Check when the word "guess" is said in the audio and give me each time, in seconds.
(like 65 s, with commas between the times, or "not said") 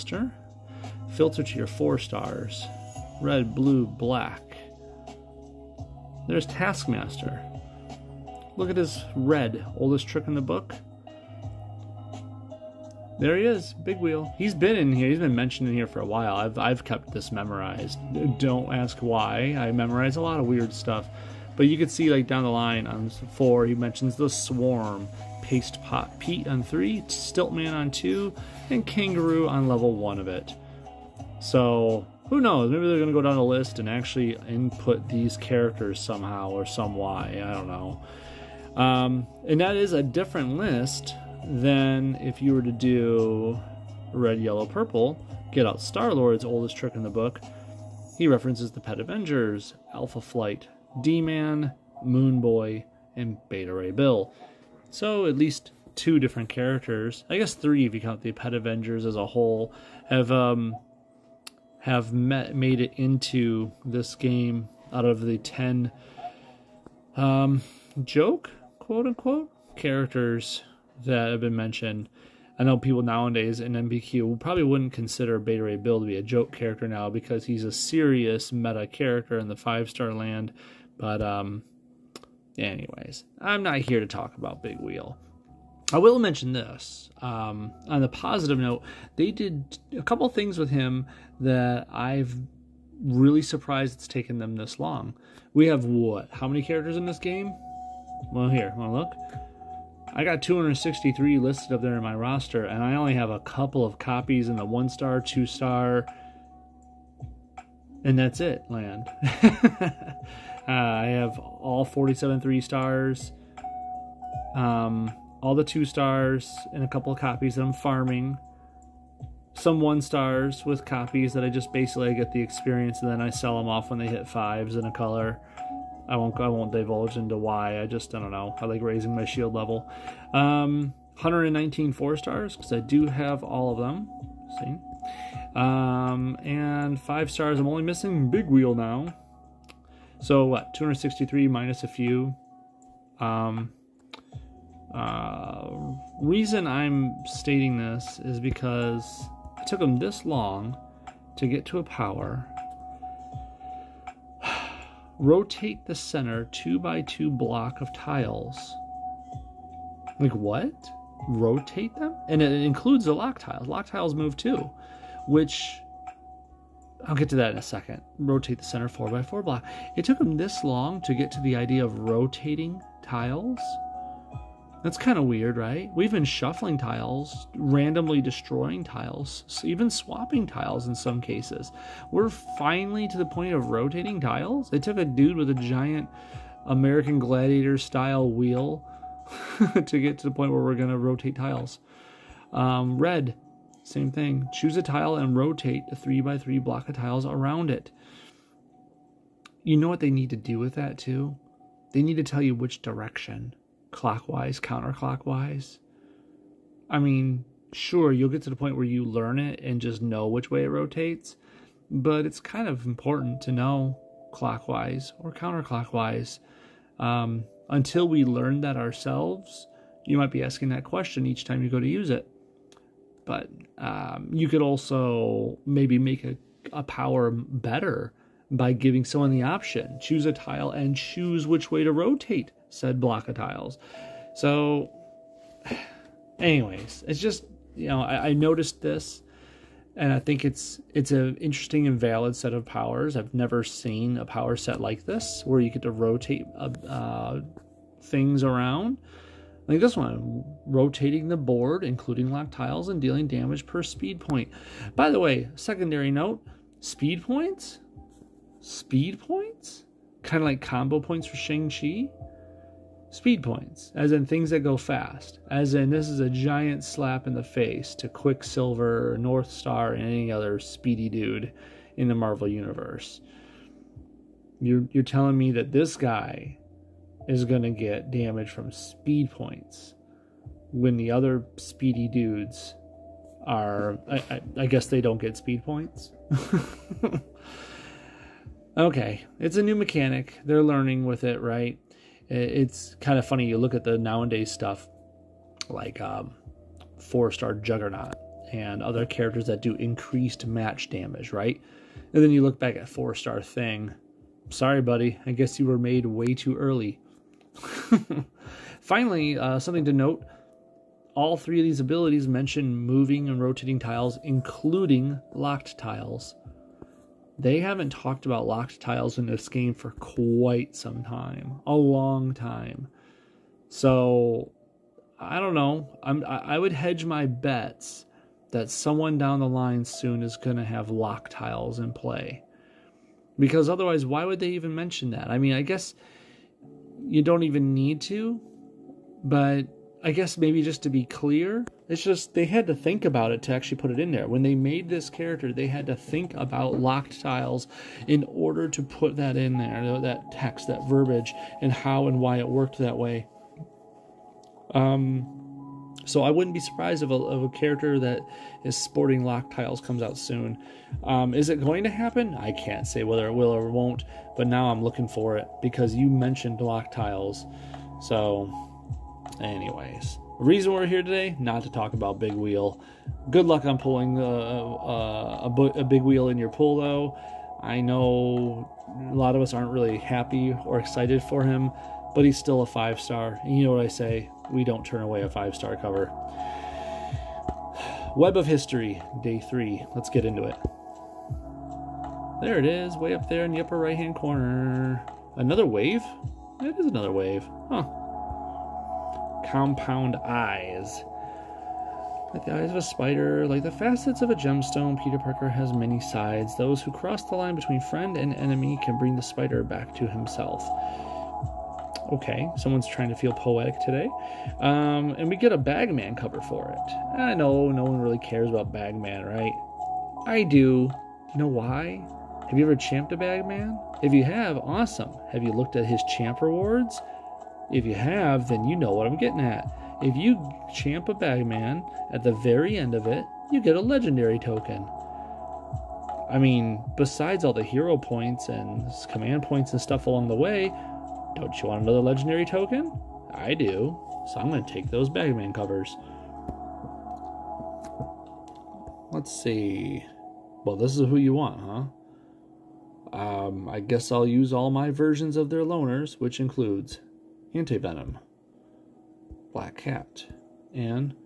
57 s, 284 s, 305 s, 335 s, 340 s, 453 s.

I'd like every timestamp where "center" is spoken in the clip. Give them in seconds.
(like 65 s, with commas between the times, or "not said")
155 s, 168 s.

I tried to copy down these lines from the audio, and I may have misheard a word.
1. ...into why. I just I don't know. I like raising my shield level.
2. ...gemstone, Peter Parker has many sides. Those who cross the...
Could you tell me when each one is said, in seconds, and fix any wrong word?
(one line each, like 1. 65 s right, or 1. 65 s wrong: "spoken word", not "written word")
1. 127 s right
2. 404 s right.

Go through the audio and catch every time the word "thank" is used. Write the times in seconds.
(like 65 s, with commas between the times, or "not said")
not said.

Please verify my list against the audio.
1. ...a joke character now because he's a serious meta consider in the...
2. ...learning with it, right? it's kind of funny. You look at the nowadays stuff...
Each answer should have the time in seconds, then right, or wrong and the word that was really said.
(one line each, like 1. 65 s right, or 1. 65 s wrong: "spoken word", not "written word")
1. 76 s wrong: "character", not "consider"
2. 290 s right.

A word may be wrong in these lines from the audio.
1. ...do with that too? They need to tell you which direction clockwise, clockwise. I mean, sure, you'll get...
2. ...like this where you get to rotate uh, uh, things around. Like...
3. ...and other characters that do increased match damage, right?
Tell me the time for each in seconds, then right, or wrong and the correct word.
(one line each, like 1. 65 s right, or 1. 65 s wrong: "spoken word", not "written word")
1. 200 s wrong: "counterclockwise", not "clockwise"
2. 244 s right
3. 298 s right.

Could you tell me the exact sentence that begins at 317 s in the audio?
They haven't talked about locked tiles in this game for quite some time, a long time.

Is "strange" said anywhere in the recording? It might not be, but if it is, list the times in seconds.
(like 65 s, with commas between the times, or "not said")
not said.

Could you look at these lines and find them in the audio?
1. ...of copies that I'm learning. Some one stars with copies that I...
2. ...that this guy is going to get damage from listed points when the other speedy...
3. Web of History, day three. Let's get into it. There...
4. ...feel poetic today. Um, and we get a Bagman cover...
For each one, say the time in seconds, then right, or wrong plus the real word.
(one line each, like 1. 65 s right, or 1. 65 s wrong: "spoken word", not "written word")
1. 117 s wrong: "farming", not "learning"
2. 275 s wrong: "speed", not "listed"
3. 388 s right
4. 413 s right.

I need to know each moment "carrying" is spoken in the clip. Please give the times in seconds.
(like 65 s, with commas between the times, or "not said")
not said.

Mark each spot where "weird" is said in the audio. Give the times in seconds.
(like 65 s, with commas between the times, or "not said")
20 s, 175 s.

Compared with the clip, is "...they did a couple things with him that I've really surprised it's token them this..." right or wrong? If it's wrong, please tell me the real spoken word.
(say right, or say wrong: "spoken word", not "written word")
wrong: "taken", not "token".